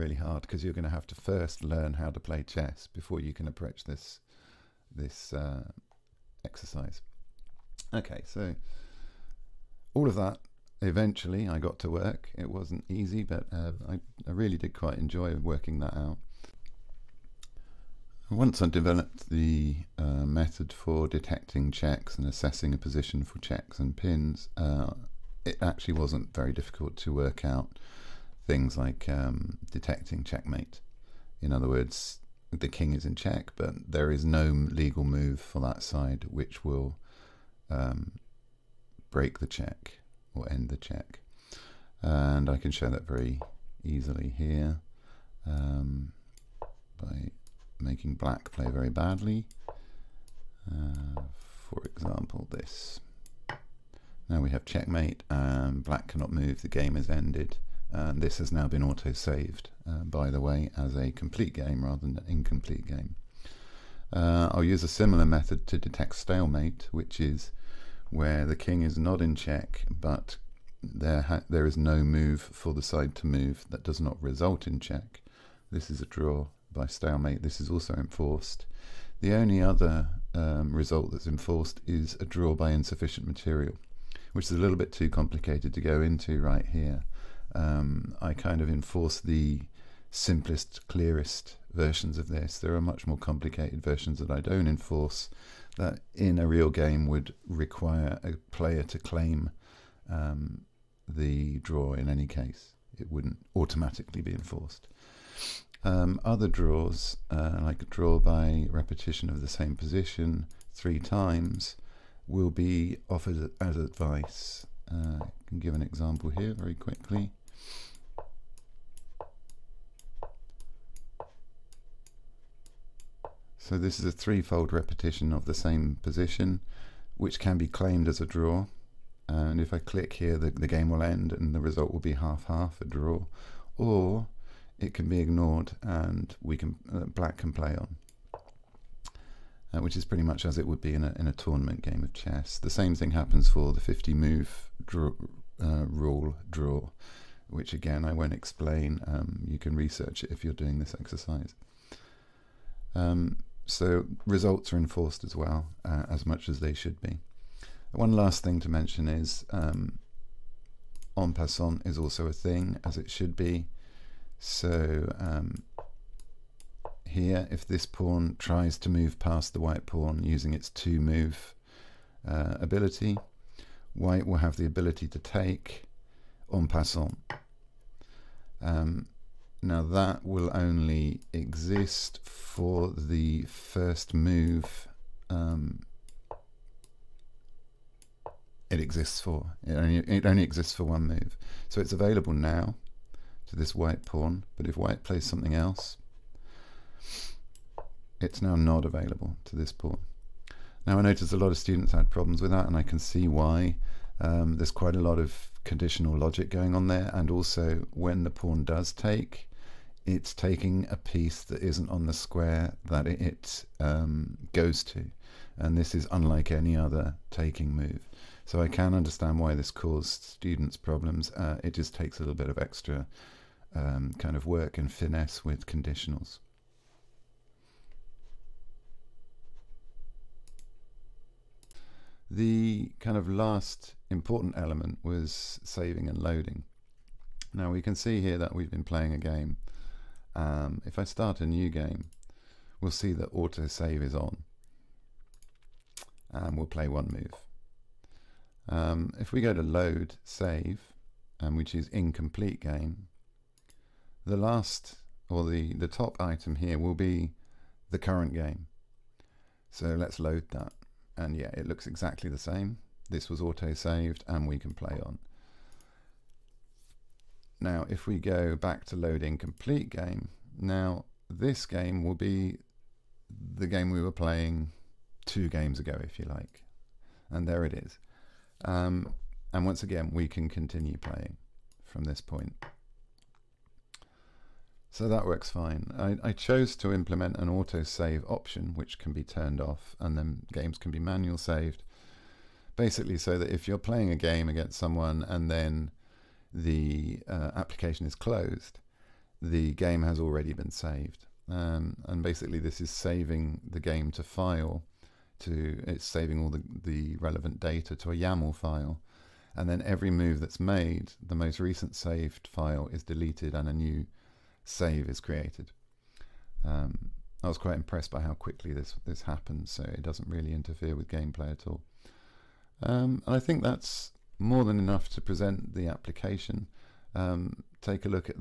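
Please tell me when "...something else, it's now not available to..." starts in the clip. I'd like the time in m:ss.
3:15.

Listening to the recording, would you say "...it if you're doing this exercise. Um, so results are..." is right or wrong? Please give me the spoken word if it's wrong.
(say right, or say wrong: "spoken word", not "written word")
right.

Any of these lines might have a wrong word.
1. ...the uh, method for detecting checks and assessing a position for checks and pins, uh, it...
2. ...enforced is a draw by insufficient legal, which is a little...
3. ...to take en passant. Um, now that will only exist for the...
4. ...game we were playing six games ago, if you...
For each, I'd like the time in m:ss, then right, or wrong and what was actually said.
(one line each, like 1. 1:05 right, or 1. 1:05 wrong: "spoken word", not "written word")
1. 0:19 right
2. 1:21 wrong: "material", not "legal"
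3. 2:55 right
4. 4:33 wrong: "two", not "six".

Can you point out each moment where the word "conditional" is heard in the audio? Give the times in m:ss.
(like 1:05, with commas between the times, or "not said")
3:25, 3:45.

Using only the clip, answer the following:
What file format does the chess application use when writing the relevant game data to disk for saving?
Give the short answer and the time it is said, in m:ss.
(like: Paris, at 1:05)
YAML, at 5:08.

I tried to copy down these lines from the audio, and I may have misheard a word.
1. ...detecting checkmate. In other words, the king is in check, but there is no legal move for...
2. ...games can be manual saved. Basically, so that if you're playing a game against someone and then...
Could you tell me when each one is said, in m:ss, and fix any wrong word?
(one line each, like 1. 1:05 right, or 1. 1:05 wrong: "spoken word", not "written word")
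1. 0:29 right
2. 4:50 right.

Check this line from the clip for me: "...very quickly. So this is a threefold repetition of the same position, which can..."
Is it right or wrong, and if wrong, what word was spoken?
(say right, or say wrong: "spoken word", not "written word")
right.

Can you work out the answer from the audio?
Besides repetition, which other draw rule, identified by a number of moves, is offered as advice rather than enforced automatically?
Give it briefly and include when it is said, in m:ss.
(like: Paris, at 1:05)
50 move rule, at 2:23.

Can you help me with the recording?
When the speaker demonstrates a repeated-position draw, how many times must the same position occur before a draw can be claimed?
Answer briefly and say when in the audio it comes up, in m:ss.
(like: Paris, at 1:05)
3, at 1:50.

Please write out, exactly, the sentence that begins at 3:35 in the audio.
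And this is unlike any other taking move.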